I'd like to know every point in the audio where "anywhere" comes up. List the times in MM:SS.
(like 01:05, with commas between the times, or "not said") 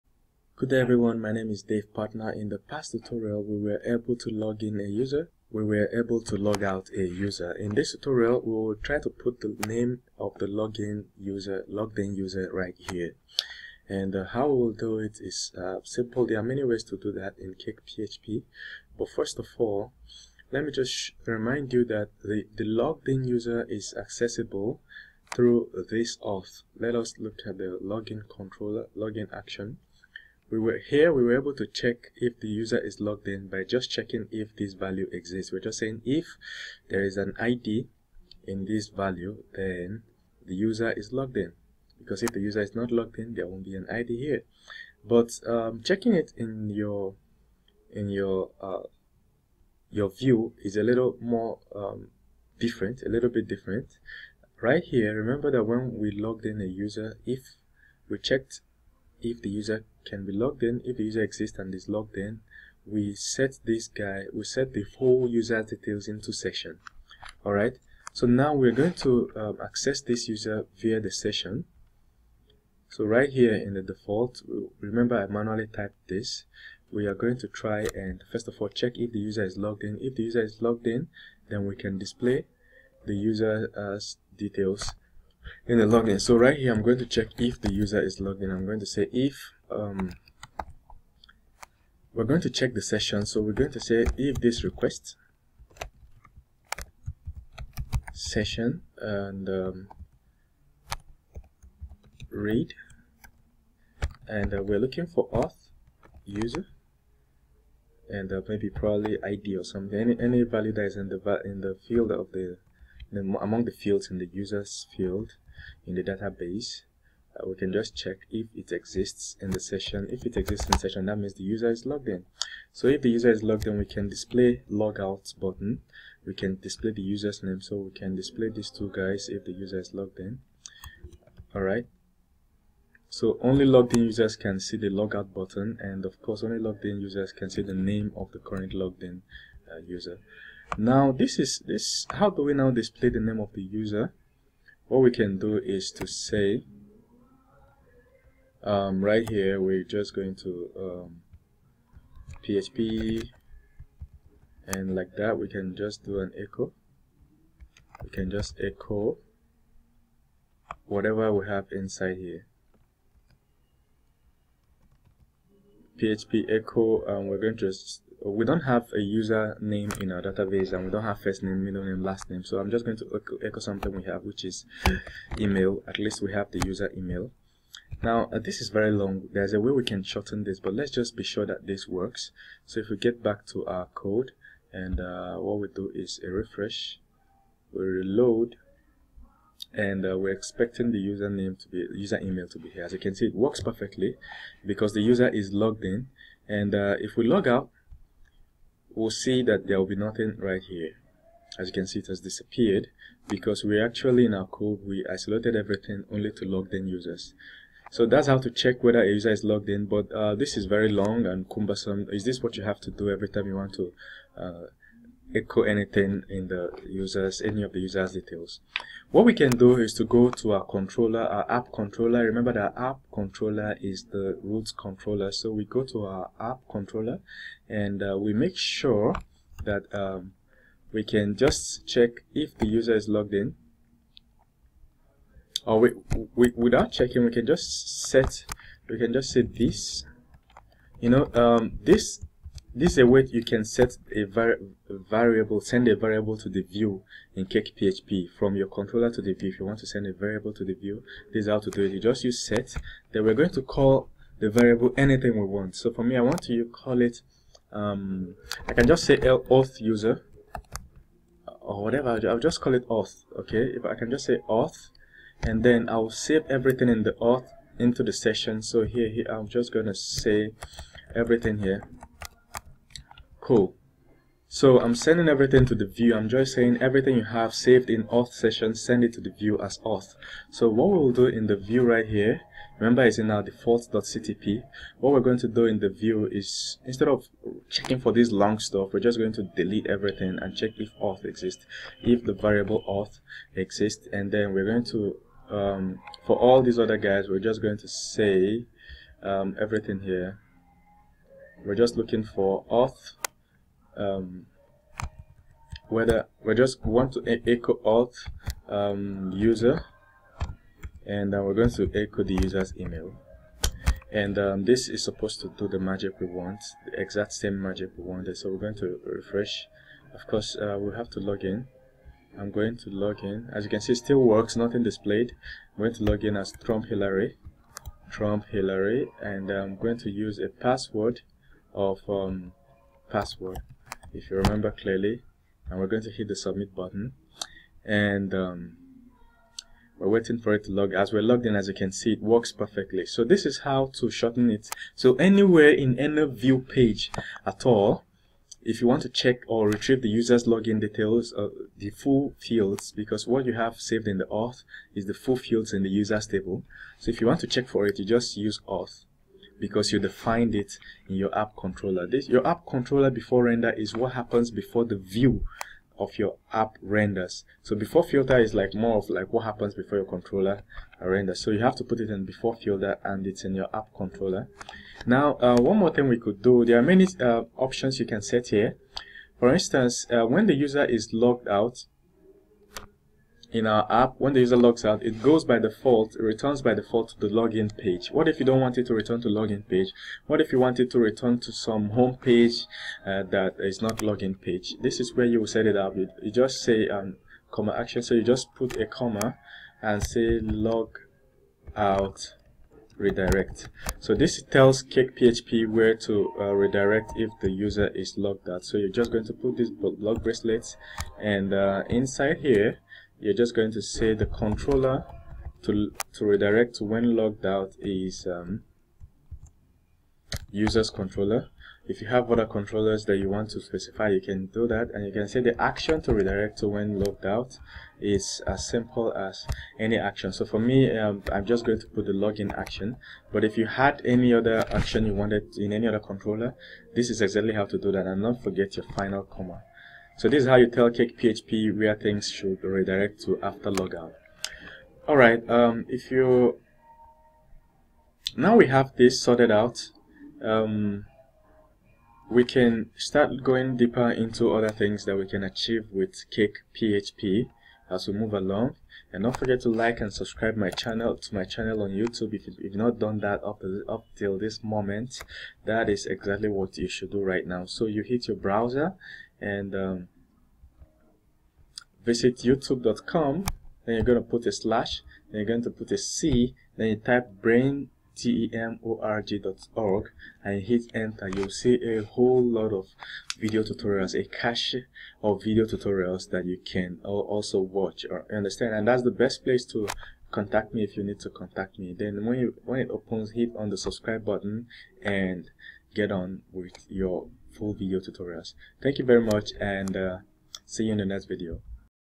05:45.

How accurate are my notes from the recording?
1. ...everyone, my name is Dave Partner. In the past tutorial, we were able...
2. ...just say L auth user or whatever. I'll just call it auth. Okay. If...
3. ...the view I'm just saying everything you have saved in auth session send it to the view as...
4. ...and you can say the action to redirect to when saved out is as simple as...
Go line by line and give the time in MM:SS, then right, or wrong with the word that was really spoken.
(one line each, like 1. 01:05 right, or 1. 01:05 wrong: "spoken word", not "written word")
1. 00:00 right
2. 04:18 right
3. 04:35 right
4. 07:04 wrong: "logged", not "saved".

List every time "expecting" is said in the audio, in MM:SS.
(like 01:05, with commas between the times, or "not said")
03:10.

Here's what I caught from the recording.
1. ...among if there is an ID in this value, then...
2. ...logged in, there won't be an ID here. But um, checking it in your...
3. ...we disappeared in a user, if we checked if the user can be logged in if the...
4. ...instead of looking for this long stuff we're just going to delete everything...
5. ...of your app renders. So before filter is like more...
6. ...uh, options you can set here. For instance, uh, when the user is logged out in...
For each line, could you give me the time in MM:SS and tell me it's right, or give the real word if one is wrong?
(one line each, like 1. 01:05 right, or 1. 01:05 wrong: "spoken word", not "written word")
1. 00:35 wrong: "saying", not "among"
2. 00:42 right
3. 00:55 wrong: "logged", not "disappeared"
4. 04:46 wrong: "checking", not "looking"
5. 06:05 right
6. 06:17 right.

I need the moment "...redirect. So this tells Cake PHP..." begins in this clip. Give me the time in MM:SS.
06:42.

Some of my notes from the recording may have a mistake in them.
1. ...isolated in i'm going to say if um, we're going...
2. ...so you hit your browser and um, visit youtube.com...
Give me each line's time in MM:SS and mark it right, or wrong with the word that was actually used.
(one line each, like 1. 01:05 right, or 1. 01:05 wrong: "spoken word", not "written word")
1. 01:28 wrong: "logged", not "isolated"
2. 07:47 right.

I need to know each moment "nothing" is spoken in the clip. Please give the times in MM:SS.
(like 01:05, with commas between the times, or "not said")
03:19, 05:24.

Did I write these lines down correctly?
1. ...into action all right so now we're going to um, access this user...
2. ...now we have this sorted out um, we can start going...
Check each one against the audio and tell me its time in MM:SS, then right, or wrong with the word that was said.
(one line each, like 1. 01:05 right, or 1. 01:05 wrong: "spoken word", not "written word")
1. 01:06 wrong: "session", not "action"
2. 07:28 right.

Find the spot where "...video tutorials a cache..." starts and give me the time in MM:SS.
08:03.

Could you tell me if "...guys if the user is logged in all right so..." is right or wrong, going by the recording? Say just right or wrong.
right.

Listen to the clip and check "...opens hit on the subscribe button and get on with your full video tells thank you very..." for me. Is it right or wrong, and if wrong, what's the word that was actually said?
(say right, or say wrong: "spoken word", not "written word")
wrong: "tutorials", not "tells".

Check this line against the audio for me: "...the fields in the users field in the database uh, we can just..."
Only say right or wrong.
right.